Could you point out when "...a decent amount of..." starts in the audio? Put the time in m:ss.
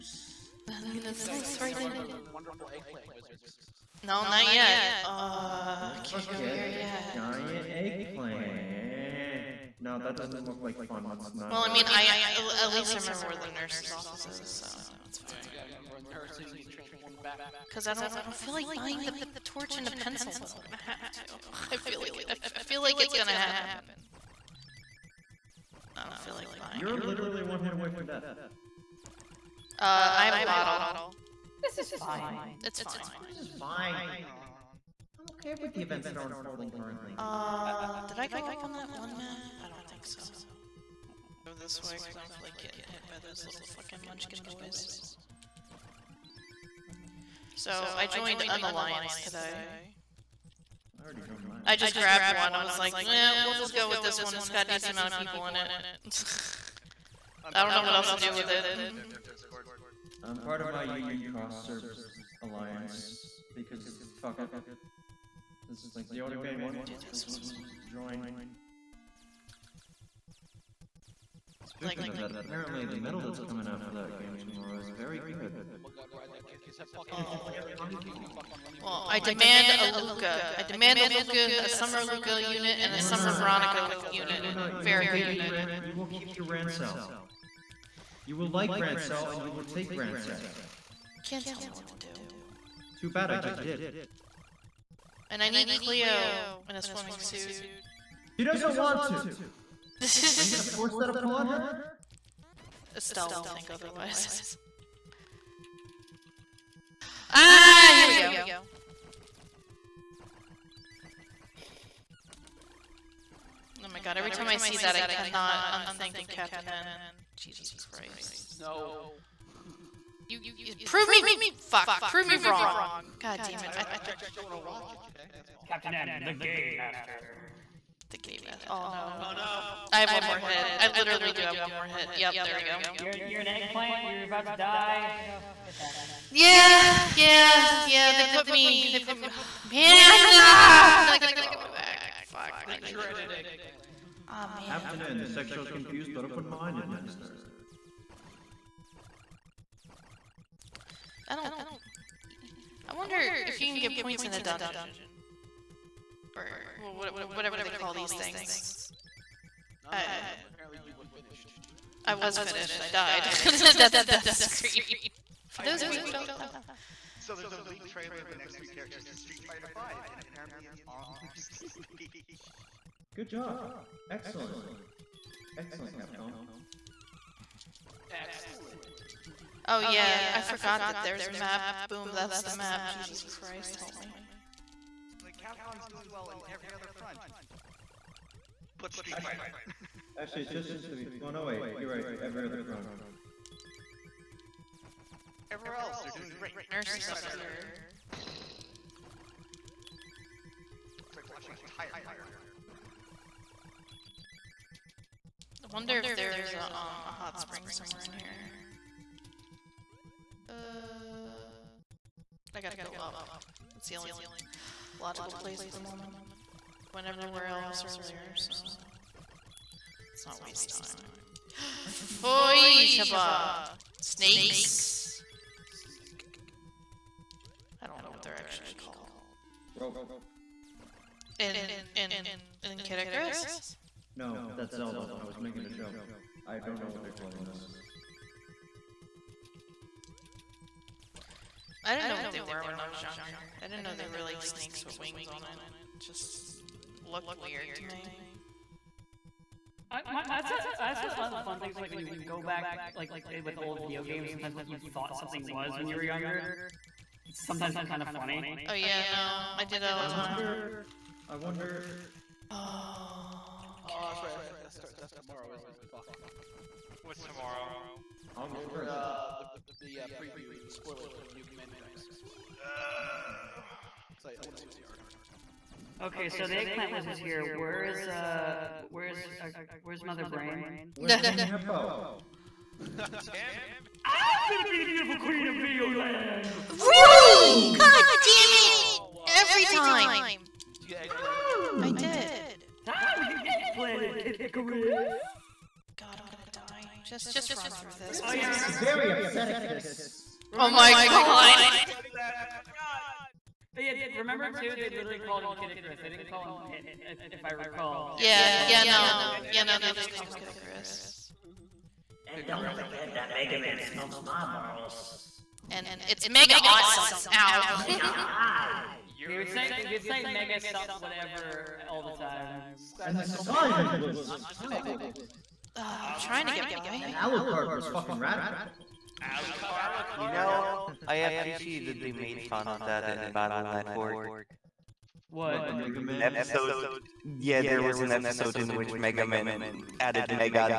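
0:54.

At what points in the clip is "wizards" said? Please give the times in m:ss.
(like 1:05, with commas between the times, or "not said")
0:03, 4:36.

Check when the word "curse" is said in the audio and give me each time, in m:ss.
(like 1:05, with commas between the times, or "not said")
not said.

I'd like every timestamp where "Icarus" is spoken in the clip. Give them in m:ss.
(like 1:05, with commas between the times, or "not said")
3:52, 4:54, 5:05, 5:10.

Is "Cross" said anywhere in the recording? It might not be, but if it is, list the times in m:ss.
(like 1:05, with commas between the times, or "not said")
1:01.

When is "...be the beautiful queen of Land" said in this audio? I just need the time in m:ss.
4:44.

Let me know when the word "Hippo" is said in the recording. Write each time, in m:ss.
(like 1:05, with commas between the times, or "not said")
4:41.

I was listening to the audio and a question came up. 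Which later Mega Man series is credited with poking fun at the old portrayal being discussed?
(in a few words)
Battle Network.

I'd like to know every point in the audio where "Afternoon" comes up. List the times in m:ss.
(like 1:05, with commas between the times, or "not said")
2:24.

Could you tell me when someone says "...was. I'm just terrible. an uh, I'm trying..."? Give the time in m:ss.
5:23.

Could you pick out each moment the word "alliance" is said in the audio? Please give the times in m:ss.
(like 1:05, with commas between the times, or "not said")
0:48, 1:02.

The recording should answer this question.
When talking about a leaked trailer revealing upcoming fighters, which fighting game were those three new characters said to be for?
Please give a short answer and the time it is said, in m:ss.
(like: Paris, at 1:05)
Street Fighter V, at 2:49.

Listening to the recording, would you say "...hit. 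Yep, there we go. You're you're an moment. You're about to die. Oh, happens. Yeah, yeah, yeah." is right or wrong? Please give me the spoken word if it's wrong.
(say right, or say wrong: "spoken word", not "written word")
wrong: "eggplant", not "moment".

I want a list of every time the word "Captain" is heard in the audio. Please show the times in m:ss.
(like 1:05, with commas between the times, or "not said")
1:56, 2:05.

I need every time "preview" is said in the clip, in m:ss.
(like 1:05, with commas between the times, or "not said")
4:30.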